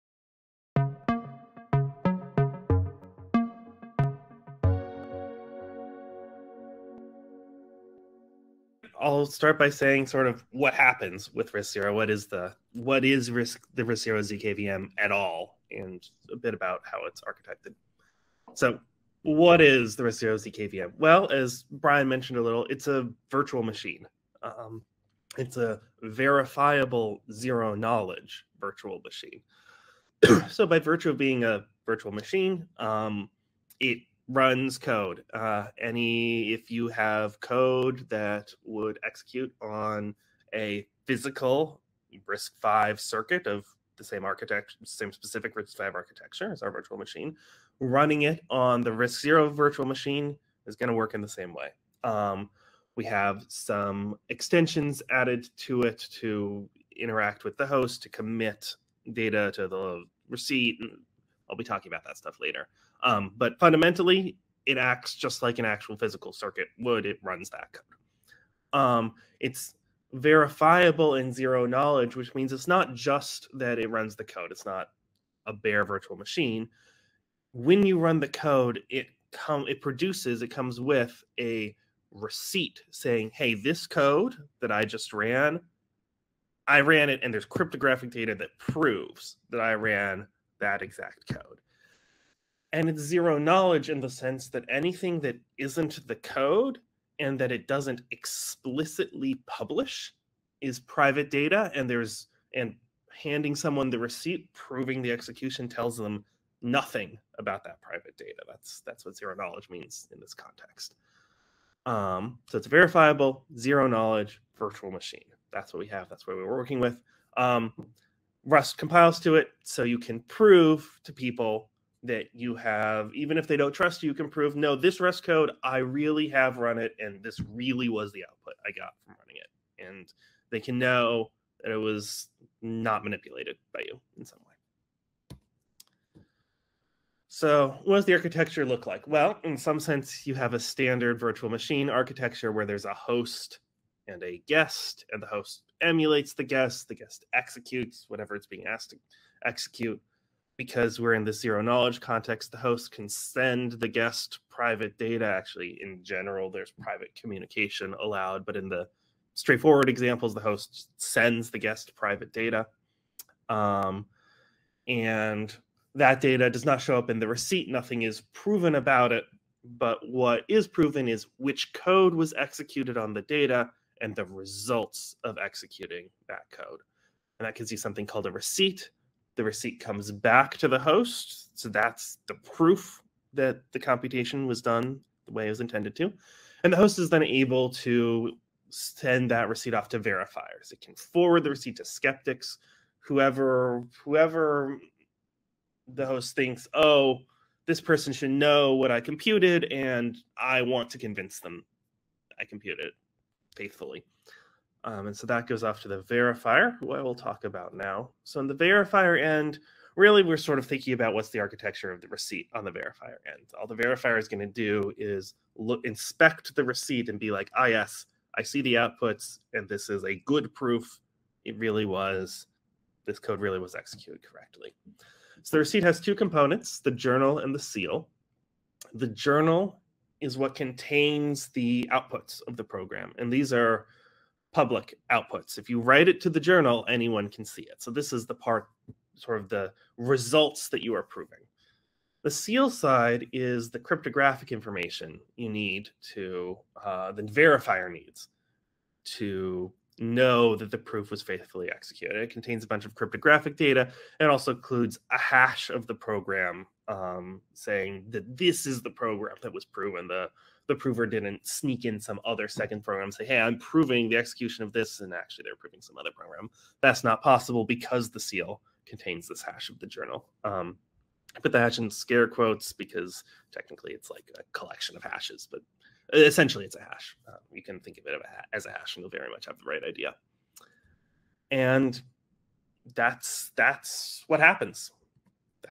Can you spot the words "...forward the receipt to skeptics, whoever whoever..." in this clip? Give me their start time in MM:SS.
03:10.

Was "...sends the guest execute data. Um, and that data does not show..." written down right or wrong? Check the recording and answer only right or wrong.
wrong.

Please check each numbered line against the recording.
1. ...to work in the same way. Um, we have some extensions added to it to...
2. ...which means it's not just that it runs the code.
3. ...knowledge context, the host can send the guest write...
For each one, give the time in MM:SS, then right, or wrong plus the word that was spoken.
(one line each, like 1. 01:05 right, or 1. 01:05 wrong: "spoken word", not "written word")
1. 00:50 right
2. 01:12 right
3. 02:31 wrong: "private", not "write".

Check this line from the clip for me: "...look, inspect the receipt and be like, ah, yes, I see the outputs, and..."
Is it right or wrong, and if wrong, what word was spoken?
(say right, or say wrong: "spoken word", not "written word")
right.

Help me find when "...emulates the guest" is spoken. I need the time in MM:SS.
02:25.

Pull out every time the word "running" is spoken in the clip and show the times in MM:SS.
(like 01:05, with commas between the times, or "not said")
00:47, 02:09.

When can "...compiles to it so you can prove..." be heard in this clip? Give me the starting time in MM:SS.
01:58.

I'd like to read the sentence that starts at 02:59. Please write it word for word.
The receipt comes back to the host.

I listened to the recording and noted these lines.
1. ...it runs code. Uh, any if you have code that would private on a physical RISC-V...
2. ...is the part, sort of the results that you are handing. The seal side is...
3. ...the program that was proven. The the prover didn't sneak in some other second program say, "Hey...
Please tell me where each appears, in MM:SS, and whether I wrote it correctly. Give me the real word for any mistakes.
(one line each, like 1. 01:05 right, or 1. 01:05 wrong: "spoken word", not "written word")
1. 00:33 wrong: "execute", not "private"
2. 03:58 wrong: "proving", not "handing"
3. 04:18 right.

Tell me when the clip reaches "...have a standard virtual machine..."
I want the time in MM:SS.
02:20.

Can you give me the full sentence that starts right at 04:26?
That's not possible because the seal contains this hash of the journal.